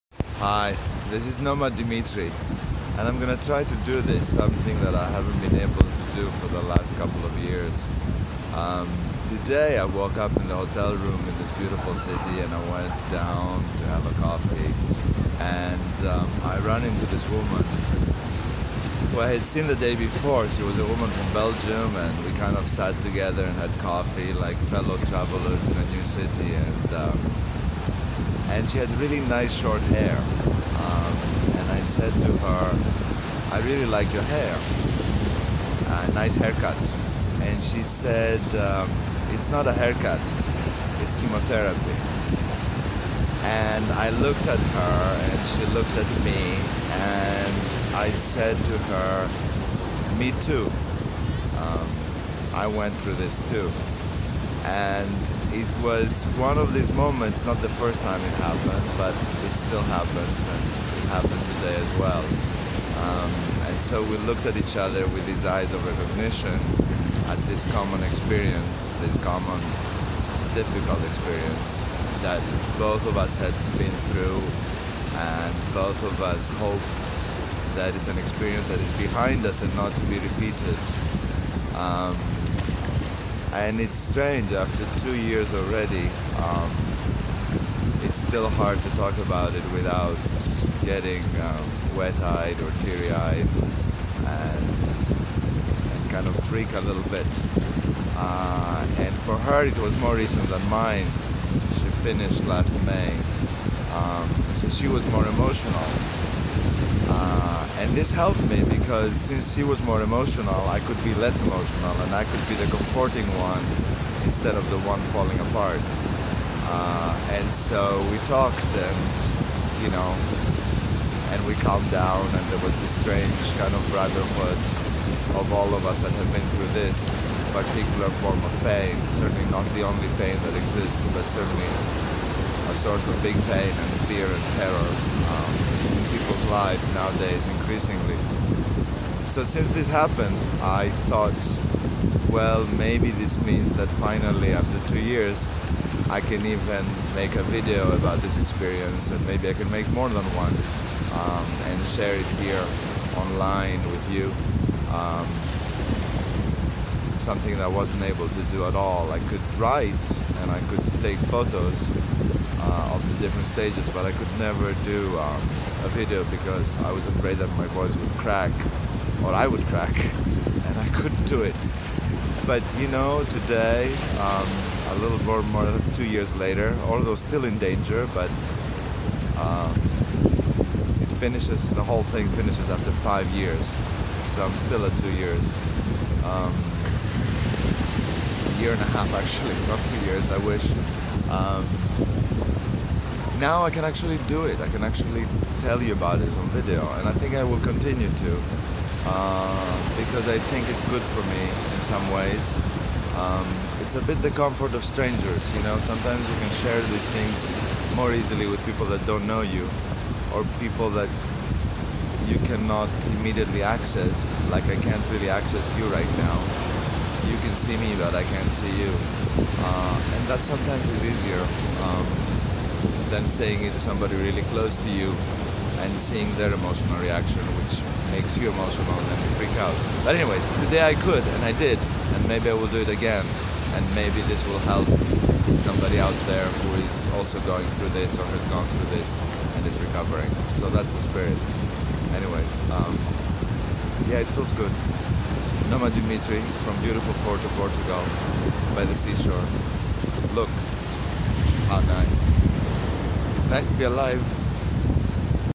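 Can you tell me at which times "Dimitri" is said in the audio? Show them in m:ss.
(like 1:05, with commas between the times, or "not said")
0:01, 4:05.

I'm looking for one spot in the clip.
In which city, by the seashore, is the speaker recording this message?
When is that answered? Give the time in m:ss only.
4:07.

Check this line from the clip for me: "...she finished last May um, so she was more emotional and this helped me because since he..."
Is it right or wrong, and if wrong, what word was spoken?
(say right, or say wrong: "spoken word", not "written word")
right.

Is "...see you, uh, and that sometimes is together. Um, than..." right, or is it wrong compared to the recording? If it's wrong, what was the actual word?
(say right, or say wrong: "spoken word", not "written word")
wrong: "easier", not "together".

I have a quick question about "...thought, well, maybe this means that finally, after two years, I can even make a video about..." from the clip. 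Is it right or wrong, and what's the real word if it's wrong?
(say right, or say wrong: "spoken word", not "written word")
right.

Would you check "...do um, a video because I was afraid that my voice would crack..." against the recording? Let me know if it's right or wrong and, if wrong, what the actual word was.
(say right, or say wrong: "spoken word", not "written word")
right.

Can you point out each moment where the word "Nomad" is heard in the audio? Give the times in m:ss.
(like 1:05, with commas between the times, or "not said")
0:01, 4:05.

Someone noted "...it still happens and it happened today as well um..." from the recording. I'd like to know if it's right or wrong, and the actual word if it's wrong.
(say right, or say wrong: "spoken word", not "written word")
right.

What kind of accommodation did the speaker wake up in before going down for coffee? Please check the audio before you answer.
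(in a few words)
Hotel room.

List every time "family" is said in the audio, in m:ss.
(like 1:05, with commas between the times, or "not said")
not said.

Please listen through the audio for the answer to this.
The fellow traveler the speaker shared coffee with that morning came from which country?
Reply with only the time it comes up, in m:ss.
0:21.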